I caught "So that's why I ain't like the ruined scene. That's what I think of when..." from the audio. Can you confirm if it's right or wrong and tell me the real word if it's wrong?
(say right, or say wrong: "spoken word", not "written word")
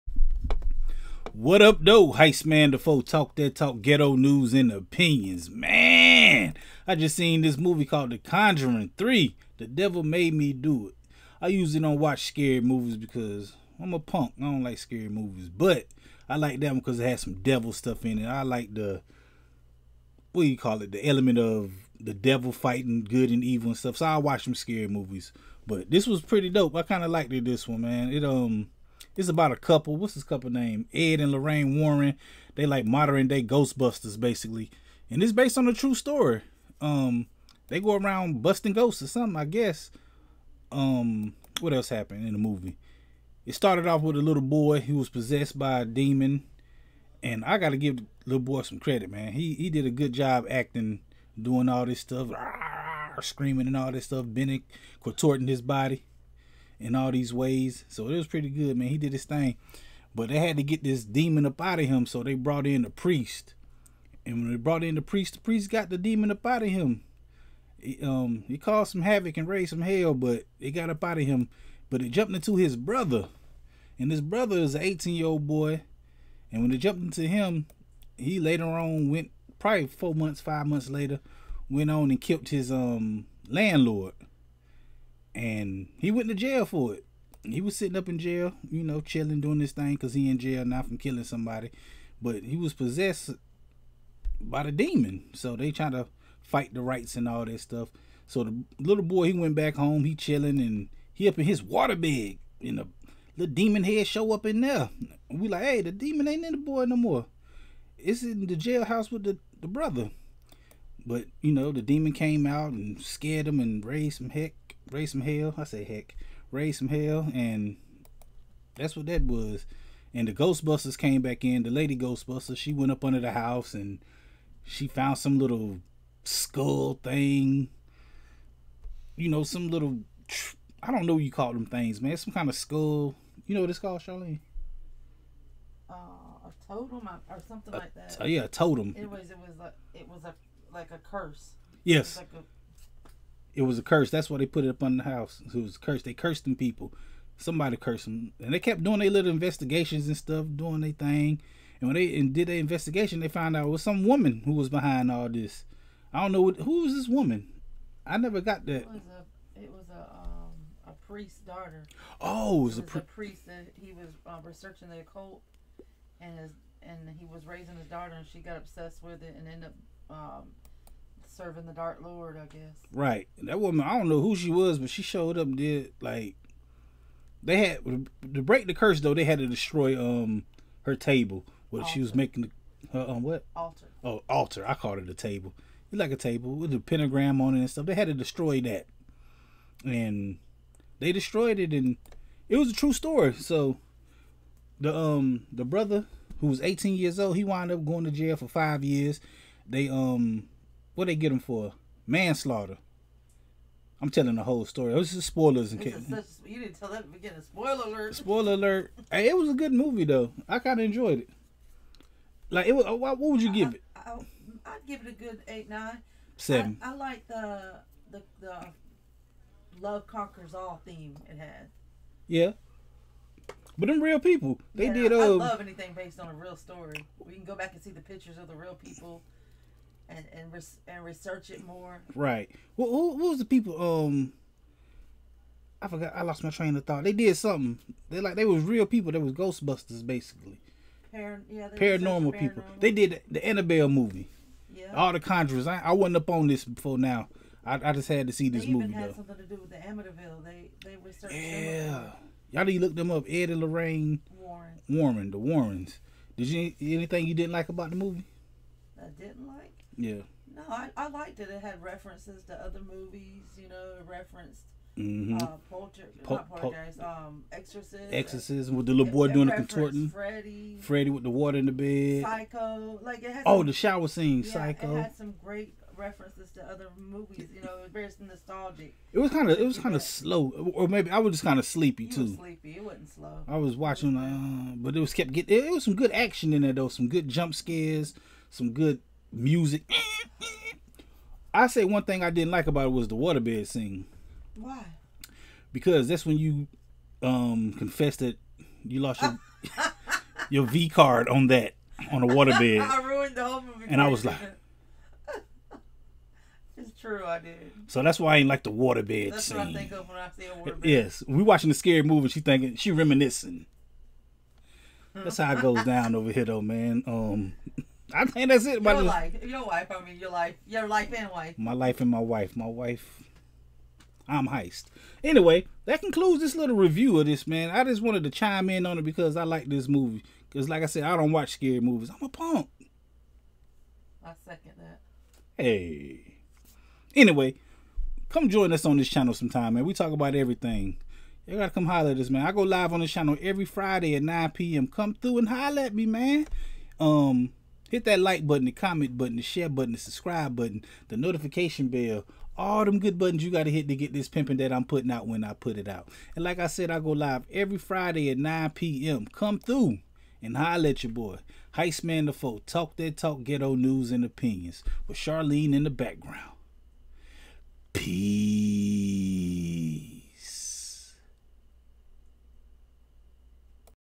wrong: "waterbed", not "ruined".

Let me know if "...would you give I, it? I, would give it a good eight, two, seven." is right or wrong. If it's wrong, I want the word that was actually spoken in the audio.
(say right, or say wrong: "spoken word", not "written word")
wrong: "nine", not "two".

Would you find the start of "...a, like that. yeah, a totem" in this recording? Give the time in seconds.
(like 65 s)
137 s.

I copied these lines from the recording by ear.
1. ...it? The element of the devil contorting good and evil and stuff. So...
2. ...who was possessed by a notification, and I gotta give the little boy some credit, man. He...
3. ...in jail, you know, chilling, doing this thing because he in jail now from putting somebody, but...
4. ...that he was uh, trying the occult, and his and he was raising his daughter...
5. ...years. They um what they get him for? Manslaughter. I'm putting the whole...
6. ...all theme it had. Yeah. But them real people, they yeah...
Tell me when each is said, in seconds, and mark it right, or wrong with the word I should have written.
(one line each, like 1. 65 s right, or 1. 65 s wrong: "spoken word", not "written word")
1. 20 s wrong: "fighting", not "contorting"
2. 44 s wrong: "demon", not "notification"
3. 88 s wrong: "killing", not "putting"
4. 163 s wrong: "researching", not "trying"
5. 198 s wrong: "telling", not "putting"
6. 220 s right.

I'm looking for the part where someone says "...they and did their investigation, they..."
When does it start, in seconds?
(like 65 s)
151 s.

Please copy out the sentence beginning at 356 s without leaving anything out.
And like I said, I go live every Friday at 9 p.m.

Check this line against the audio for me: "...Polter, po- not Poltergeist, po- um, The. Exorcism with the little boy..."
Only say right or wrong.
wrong.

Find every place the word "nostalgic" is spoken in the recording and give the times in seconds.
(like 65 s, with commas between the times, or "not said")
278 s.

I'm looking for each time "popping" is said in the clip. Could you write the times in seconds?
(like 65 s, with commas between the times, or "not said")
not said.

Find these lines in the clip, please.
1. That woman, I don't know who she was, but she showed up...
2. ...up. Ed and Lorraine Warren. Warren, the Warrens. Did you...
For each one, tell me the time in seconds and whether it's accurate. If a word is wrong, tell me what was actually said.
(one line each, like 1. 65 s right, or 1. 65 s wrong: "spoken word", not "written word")
1. 173 s right
2. 253 s right.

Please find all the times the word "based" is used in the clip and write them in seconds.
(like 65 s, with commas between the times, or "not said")
35 s, 225 s.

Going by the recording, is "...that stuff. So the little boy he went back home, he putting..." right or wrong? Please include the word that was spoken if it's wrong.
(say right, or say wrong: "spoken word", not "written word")
wrong: "chilling", not "putting".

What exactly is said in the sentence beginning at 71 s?
But it jumped into his brother.